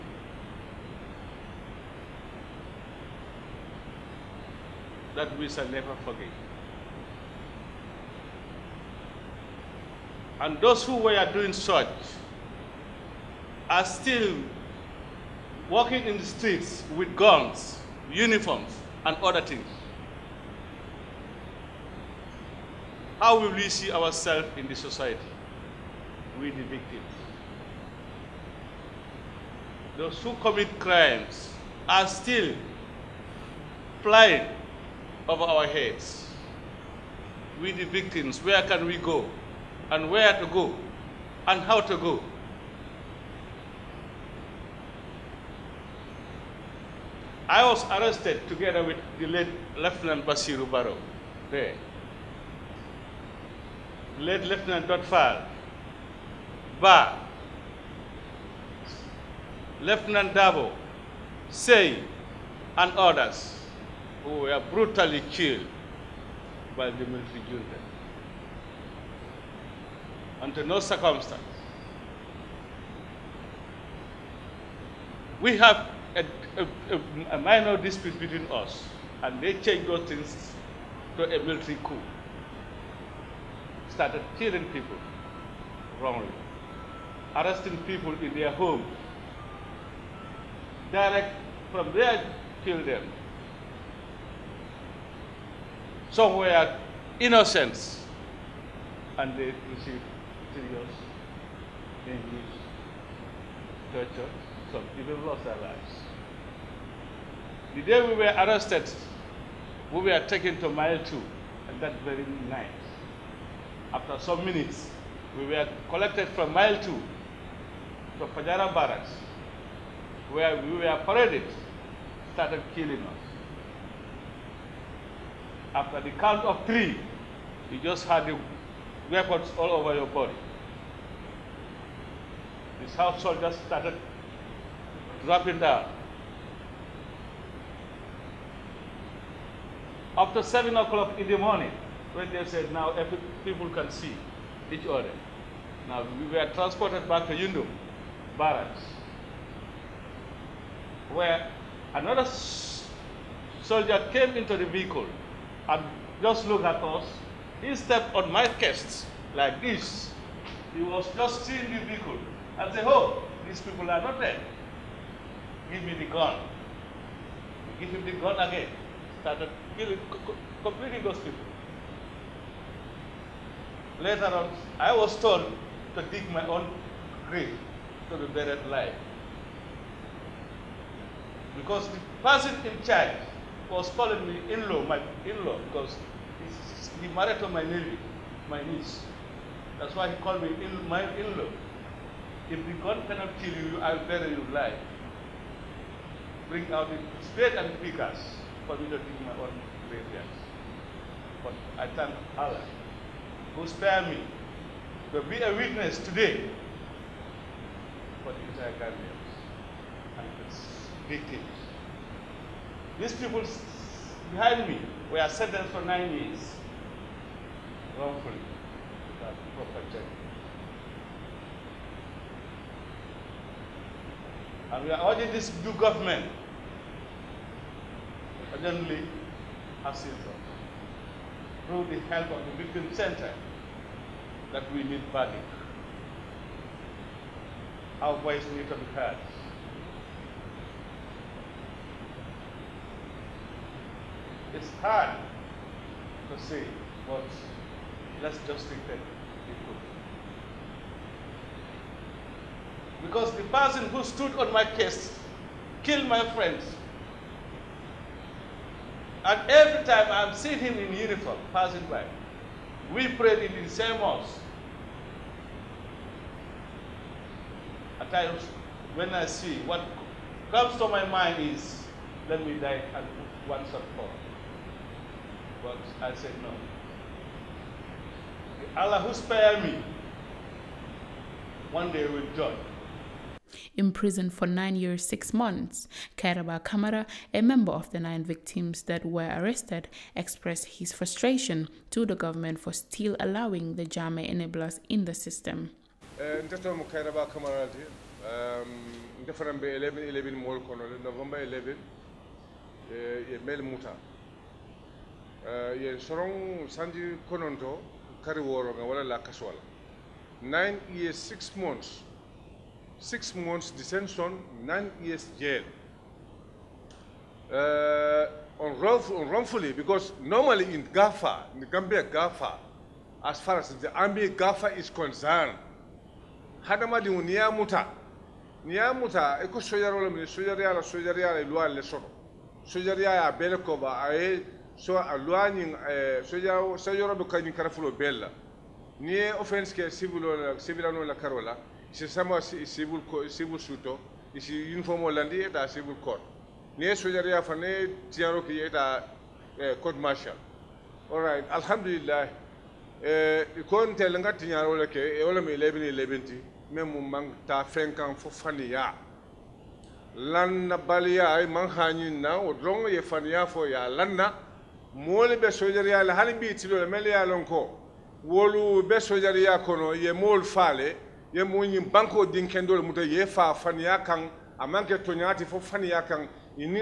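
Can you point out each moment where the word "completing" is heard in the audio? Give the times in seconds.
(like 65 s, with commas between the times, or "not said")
170 s.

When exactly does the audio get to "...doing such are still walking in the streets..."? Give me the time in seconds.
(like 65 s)
11 s.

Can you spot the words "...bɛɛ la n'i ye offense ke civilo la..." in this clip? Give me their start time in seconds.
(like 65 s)
337 s.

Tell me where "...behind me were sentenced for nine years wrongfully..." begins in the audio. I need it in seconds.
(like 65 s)
214 s.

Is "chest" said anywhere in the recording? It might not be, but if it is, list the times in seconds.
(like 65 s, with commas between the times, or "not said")
158 s.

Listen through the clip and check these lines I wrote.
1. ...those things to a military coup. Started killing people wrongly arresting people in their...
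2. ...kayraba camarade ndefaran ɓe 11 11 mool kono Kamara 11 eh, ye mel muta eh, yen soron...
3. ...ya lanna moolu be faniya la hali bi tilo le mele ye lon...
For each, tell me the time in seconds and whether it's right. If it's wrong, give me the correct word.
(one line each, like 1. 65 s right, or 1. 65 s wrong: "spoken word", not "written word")
1. 79 s right
2. 296 s wrong: "November", not "Kamara"
3. 363 s wrong: "sojariya", not "faniya".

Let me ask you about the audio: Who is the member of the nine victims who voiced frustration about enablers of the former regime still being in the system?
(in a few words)
Kairaba Kamara.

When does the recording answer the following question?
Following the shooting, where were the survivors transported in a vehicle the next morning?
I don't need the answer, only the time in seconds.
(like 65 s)
147 s.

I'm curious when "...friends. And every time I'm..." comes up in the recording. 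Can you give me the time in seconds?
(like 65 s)
256 s.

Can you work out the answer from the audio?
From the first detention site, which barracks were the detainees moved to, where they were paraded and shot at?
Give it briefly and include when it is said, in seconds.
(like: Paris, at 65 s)
Fajara barracks, at 118 s.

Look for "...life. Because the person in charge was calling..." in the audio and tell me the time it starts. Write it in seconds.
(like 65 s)
178 s.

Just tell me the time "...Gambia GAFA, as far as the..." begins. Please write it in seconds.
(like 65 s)
321 s.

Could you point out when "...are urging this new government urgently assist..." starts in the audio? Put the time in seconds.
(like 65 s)
224 s.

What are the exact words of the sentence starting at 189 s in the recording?
That's why he called me in, my in-law.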